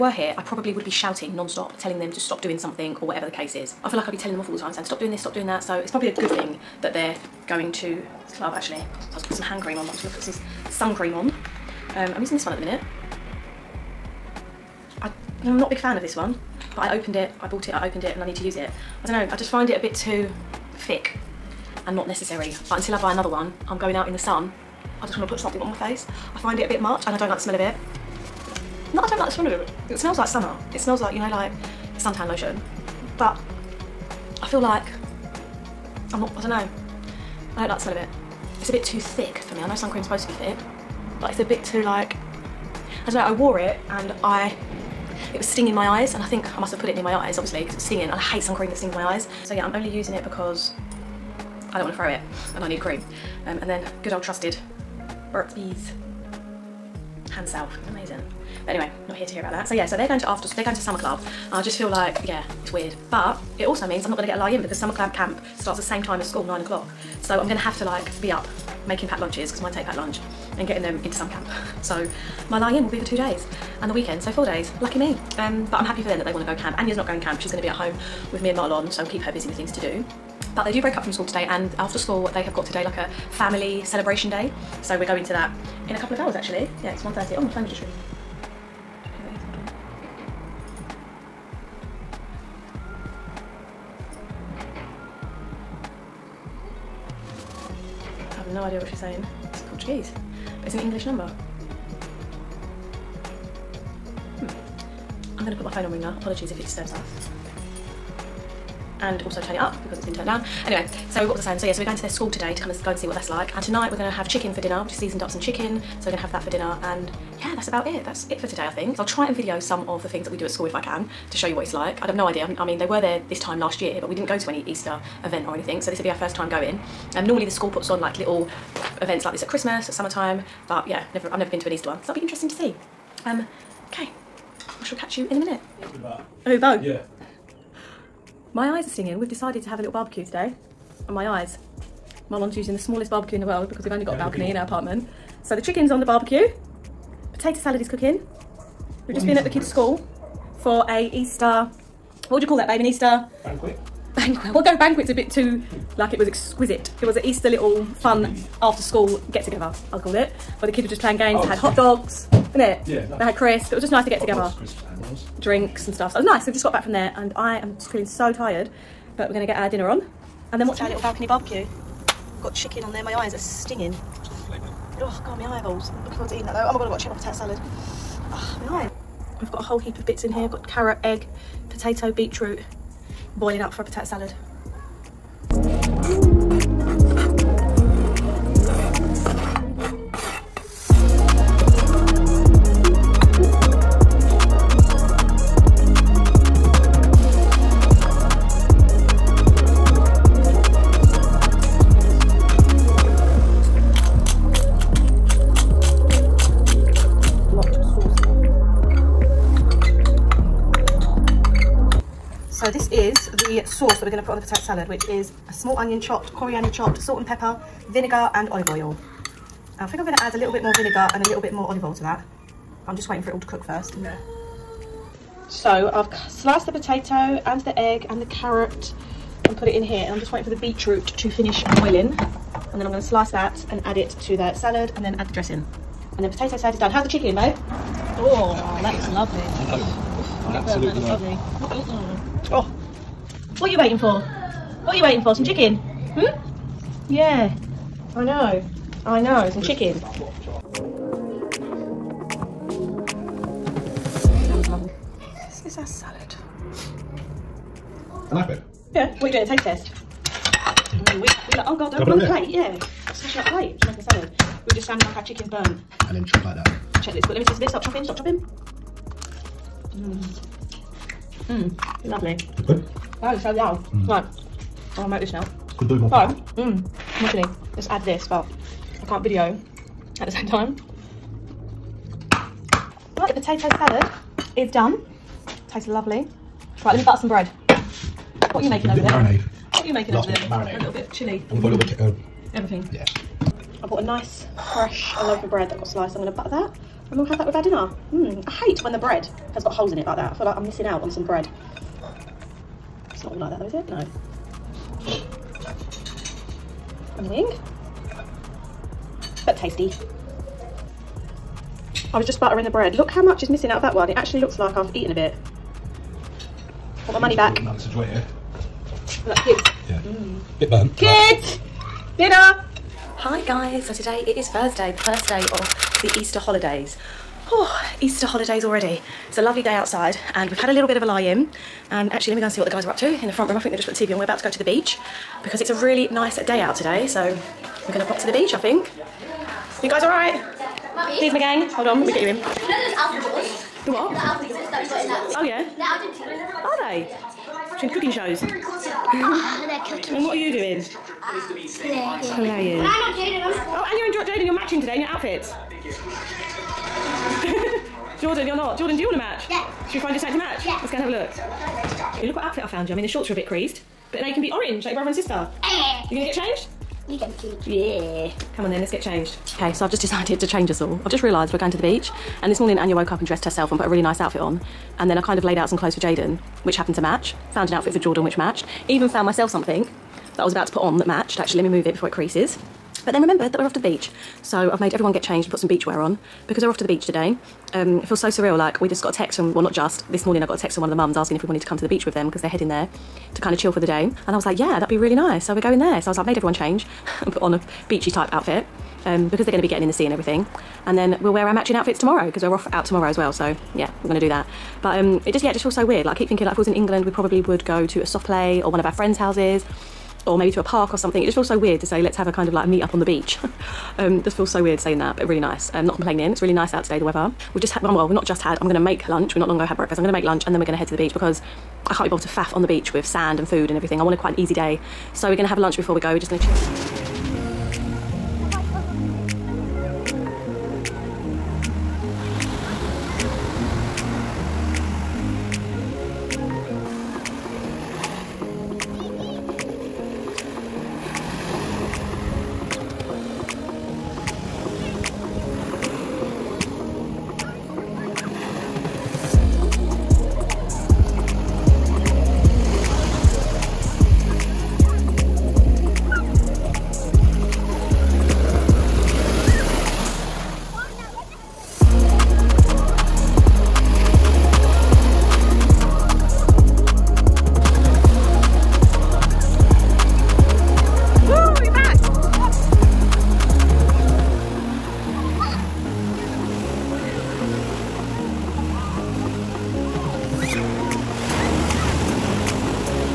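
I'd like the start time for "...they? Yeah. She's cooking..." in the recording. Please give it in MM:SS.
05:46.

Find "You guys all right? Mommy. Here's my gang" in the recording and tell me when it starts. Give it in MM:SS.
05:39.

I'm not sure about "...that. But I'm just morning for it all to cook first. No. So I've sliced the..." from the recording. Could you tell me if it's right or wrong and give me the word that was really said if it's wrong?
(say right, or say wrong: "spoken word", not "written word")
wrong: "waiting", not "morning".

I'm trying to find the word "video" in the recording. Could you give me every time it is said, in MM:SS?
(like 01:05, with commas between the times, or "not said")
01:59, 04:39.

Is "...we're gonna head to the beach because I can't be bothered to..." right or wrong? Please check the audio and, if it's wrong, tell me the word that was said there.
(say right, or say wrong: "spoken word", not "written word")
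right.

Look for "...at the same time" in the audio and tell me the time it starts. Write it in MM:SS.
04:40.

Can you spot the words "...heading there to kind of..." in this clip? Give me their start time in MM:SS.
06:32.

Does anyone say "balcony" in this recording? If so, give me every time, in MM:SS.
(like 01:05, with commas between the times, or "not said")
02:24, 02:50.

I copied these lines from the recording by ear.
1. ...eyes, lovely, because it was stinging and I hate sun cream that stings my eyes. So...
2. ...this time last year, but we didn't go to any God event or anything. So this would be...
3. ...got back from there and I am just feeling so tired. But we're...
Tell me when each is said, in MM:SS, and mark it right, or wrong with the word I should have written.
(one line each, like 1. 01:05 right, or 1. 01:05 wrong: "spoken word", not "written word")
1. 00:47 wrong: "obviously", not "lovely"
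2. 02:03 wrong: "Easter", not "God"
3. 02:46 right.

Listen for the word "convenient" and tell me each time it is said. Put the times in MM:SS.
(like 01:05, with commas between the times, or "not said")
not said.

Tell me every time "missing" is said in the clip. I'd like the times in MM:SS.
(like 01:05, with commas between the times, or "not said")
05:00, 05:13.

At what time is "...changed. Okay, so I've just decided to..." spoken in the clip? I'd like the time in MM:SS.
06:09.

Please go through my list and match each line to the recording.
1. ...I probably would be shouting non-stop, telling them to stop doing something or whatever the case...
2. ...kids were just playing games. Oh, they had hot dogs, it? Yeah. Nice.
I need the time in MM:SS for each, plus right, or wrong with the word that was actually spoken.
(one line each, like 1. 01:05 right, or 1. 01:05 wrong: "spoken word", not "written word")
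1. 00:00 right
2. 02:40 right.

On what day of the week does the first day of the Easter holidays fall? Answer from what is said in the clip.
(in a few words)
Thursday.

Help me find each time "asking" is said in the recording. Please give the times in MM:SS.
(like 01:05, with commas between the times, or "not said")
06:31.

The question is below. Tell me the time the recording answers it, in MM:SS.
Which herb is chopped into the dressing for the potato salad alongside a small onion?
03:36.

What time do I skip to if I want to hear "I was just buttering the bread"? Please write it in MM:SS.
05:12.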